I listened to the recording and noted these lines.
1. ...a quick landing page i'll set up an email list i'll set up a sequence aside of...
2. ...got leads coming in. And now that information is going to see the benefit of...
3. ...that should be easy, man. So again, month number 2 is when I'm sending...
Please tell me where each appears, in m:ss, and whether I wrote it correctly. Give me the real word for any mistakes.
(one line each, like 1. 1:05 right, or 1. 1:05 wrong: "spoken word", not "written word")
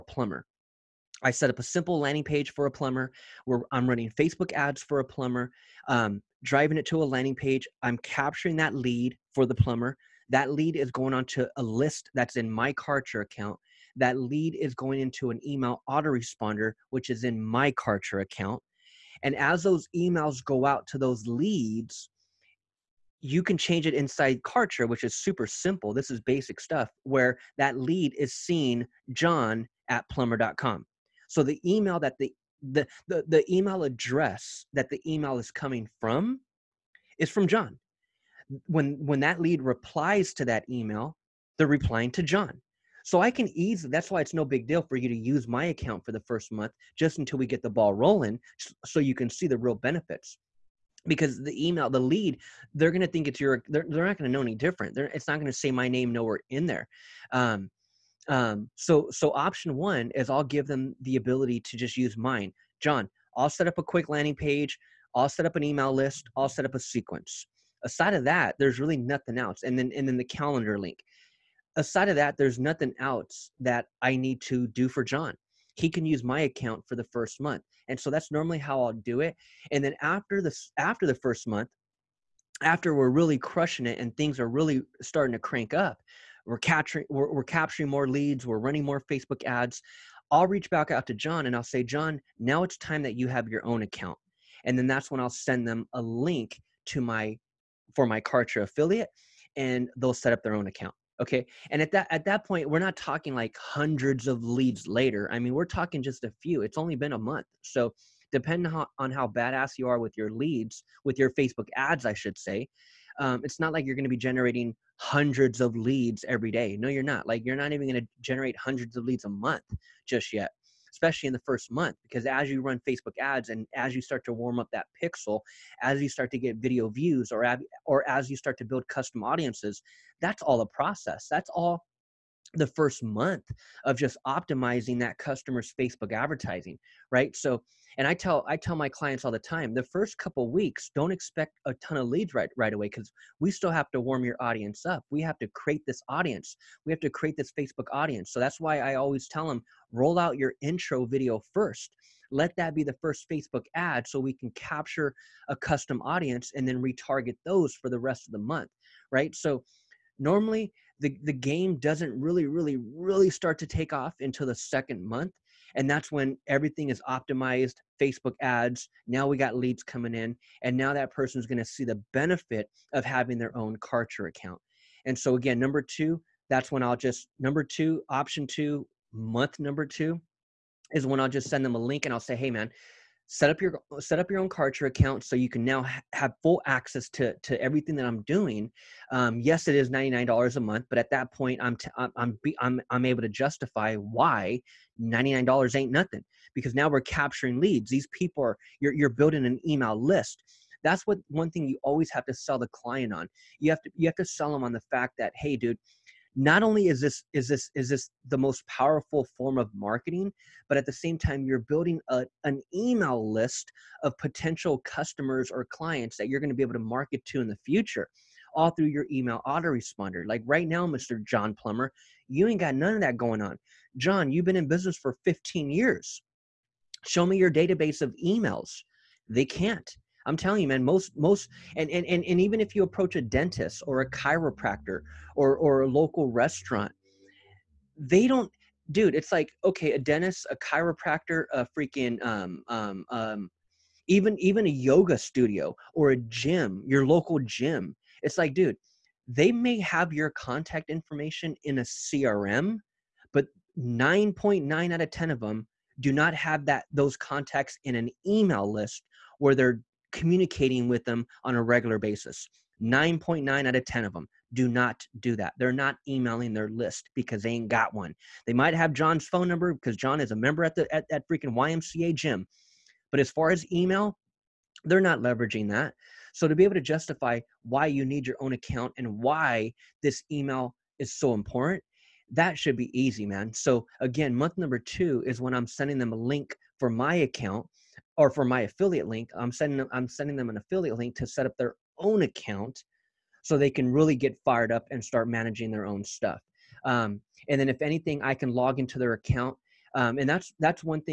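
1. 1:03 right
2. 2:49 wrong: "person", not "information"
3. 4:42 right.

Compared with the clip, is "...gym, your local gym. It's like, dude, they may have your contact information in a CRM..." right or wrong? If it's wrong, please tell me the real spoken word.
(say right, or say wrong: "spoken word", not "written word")
right.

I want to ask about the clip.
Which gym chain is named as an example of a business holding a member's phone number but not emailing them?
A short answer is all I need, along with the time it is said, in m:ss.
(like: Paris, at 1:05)
YMCA, at 4:31.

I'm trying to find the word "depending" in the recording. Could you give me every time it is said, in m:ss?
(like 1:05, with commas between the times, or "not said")
1:48.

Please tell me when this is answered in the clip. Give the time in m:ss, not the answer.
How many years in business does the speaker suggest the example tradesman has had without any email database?
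3:45.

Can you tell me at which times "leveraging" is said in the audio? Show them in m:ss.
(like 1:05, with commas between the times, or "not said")
4:35.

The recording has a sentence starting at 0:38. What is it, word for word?
When when that lead replies to that email, they're replying to John.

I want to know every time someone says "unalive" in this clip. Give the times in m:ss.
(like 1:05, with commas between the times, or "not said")
not said.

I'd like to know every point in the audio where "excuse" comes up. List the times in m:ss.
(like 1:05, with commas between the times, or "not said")
not said.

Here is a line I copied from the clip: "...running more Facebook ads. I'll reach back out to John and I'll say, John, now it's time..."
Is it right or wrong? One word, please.
right.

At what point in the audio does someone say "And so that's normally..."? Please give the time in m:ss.
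1:17.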